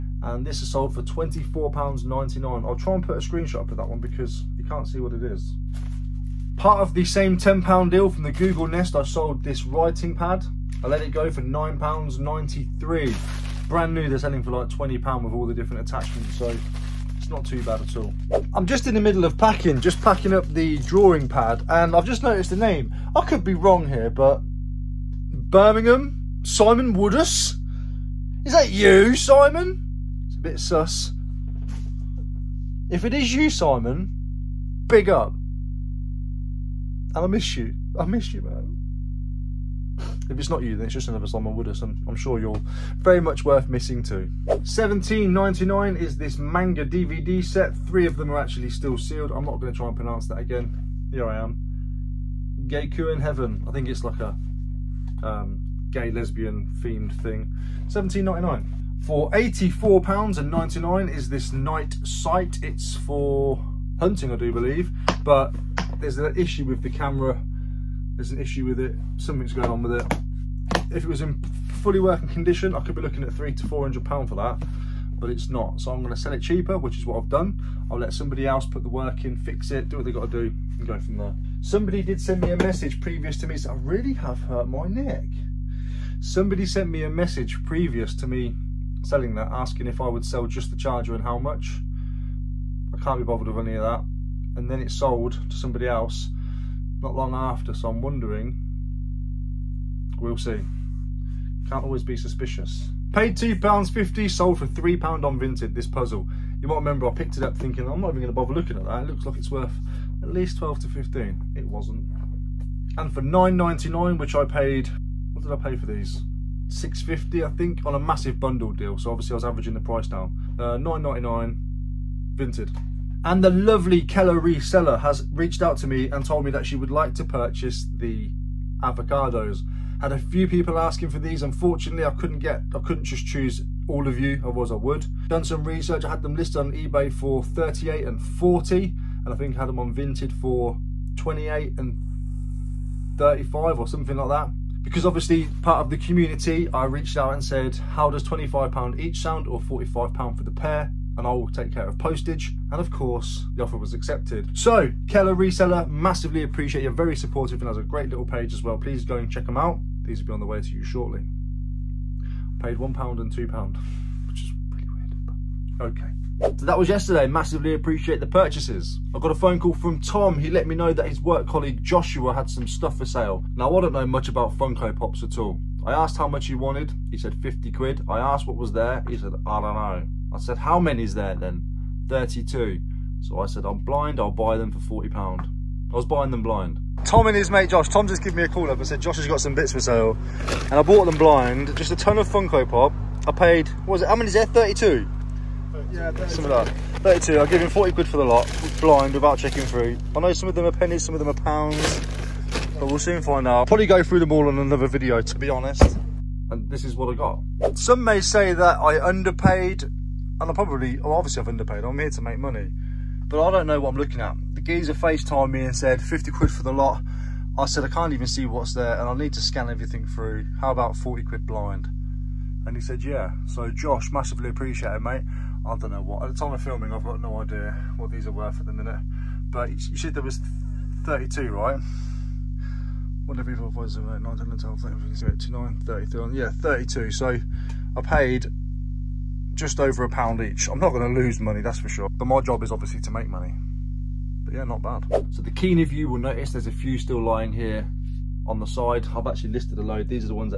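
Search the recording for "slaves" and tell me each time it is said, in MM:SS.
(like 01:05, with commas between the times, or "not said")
not said.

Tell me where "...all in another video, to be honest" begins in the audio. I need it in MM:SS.
03:24.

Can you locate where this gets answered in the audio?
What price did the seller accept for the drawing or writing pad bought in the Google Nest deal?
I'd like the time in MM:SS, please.
00:11.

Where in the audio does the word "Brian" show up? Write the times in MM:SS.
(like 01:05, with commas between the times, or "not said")
not said.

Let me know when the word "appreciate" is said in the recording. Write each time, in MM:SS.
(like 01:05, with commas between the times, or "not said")
02:36, 02:47, 03:44.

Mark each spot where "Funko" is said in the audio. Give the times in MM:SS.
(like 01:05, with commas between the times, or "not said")
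02:54, 03:12.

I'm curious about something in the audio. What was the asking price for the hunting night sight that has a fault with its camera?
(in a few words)
£84.99.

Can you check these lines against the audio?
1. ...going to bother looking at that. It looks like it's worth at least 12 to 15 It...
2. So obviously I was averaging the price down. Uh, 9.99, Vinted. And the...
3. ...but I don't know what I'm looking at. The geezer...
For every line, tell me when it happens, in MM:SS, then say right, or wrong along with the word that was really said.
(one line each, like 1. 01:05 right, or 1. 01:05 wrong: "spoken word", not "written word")
1. 01:48 right
2. 01:58 right
3. 03:33 right.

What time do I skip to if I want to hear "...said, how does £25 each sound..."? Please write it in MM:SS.
02:27.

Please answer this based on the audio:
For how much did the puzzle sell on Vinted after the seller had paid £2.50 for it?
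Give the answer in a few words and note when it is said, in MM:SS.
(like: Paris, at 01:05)
£3, at 01:44.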